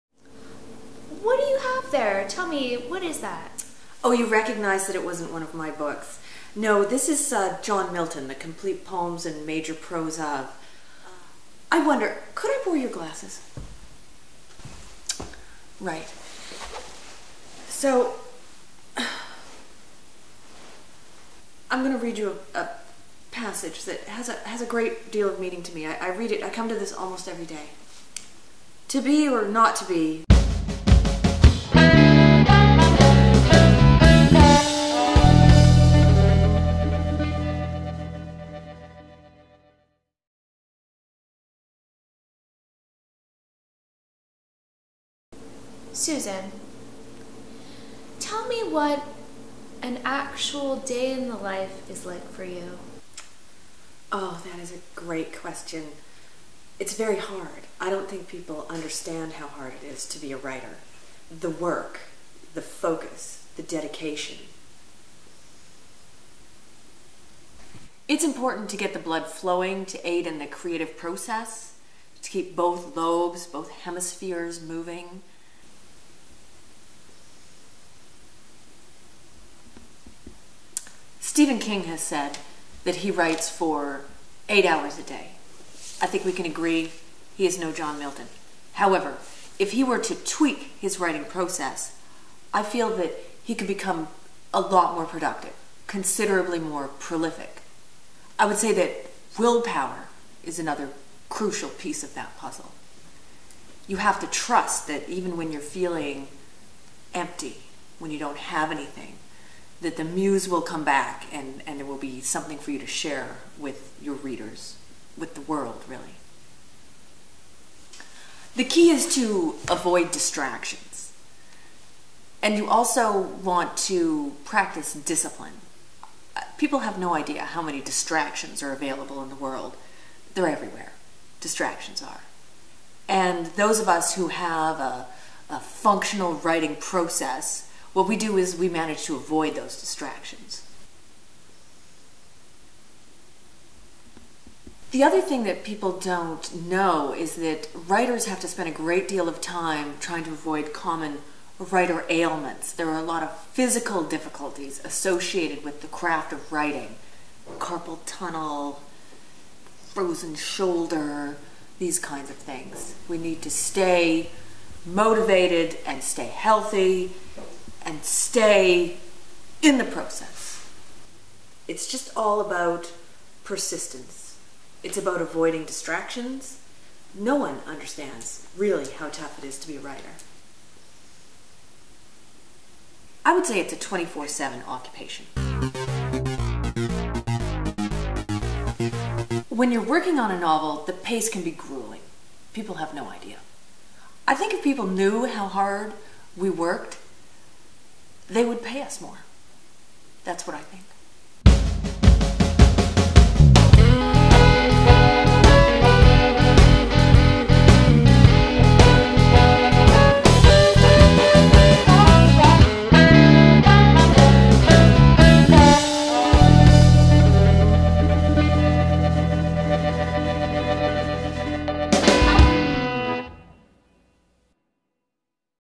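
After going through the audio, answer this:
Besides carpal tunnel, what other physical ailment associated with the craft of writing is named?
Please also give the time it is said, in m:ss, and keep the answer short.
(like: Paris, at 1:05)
frozen shoulder, at 2:39.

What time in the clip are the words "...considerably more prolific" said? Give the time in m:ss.
1:35.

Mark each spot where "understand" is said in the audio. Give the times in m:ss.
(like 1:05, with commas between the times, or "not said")
0:58, 2:57.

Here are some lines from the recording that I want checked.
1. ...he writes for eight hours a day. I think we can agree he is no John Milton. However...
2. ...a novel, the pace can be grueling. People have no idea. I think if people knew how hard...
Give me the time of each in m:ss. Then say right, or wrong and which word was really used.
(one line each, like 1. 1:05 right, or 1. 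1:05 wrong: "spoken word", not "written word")
1. 1:22 right
2. 3:10 right.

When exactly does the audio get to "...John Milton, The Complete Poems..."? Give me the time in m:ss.
0:07.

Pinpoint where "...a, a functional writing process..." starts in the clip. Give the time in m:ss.
2:14.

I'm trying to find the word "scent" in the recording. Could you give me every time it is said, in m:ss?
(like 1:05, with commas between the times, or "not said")
not said.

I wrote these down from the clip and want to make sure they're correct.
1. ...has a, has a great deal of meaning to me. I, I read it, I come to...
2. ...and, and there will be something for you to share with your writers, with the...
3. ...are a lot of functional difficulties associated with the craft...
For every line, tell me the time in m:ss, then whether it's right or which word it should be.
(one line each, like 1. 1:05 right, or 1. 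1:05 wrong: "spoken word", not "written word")
1. 0:24 right
2. 1:51 wrong: "readers", not "writers"
3. 2:32 wrong: "physical", not "functional".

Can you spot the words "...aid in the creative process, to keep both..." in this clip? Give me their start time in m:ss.
1:10.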